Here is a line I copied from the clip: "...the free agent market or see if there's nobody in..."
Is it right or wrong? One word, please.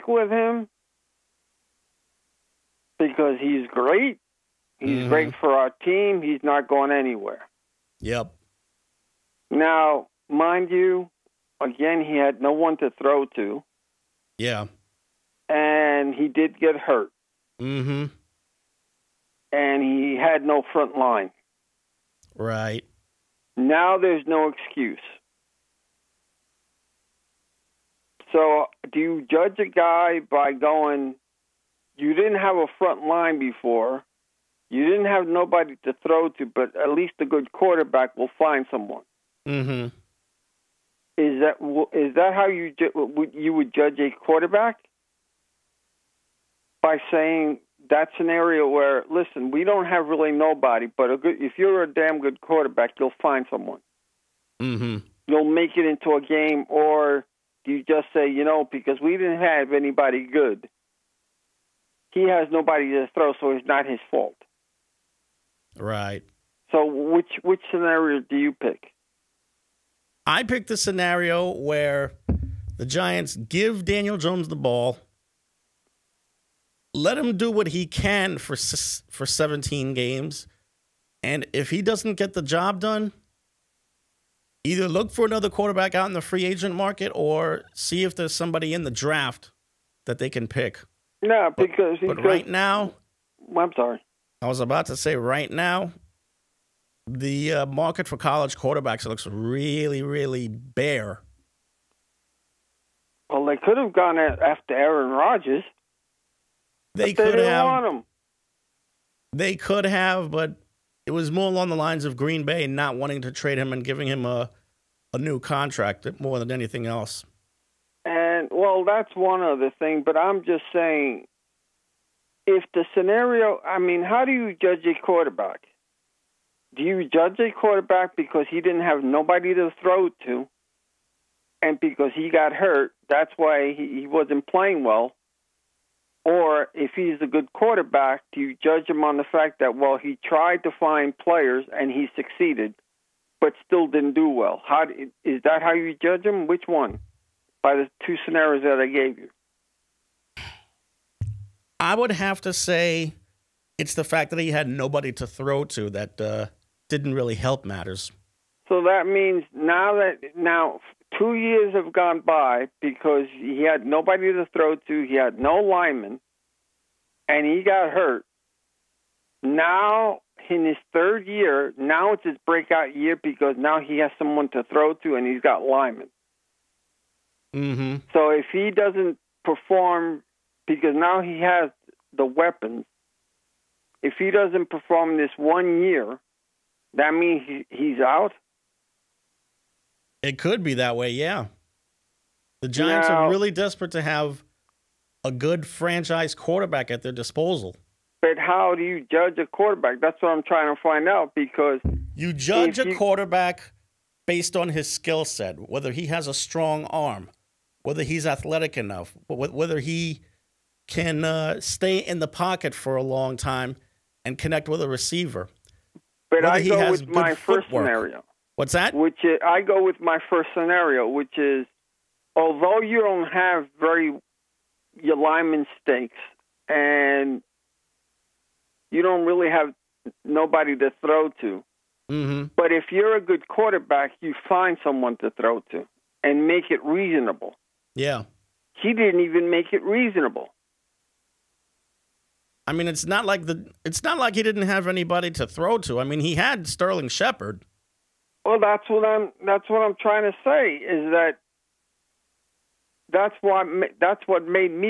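wrong.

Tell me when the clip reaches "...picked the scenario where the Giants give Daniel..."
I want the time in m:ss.
1:10.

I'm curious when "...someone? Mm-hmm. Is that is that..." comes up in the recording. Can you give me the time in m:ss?
0:38.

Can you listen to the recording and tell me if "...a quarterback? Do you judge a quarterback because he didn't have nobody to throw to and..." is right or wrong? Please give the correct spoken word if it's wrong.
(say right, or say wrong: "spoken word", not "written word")
right.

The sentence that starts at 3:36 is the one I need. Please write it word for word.
But whether I go with my footwork.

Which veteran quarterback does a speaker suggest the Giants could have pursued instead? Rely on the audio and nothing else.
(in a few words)
Aaron Rodgers.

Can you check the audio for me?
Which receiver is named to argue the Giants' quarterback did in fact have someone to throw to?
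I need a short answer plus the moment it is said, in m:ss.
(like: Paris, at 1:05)
Sterling Shepard, at 4:06.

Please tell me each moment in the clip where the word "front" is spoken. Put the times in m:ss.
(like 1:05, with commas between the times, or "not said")
0:20, 0:32.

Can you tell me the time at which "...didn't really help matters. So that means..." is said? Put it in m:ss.
2:36.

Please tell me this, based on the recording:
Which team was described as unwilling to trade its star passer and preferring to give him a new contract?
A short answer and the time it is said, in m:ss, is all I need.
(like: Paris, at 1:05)
Green Bay, at 1:52.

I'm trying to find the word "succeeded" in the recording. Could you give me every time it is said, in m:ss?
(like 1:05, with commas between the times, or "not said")
2:22.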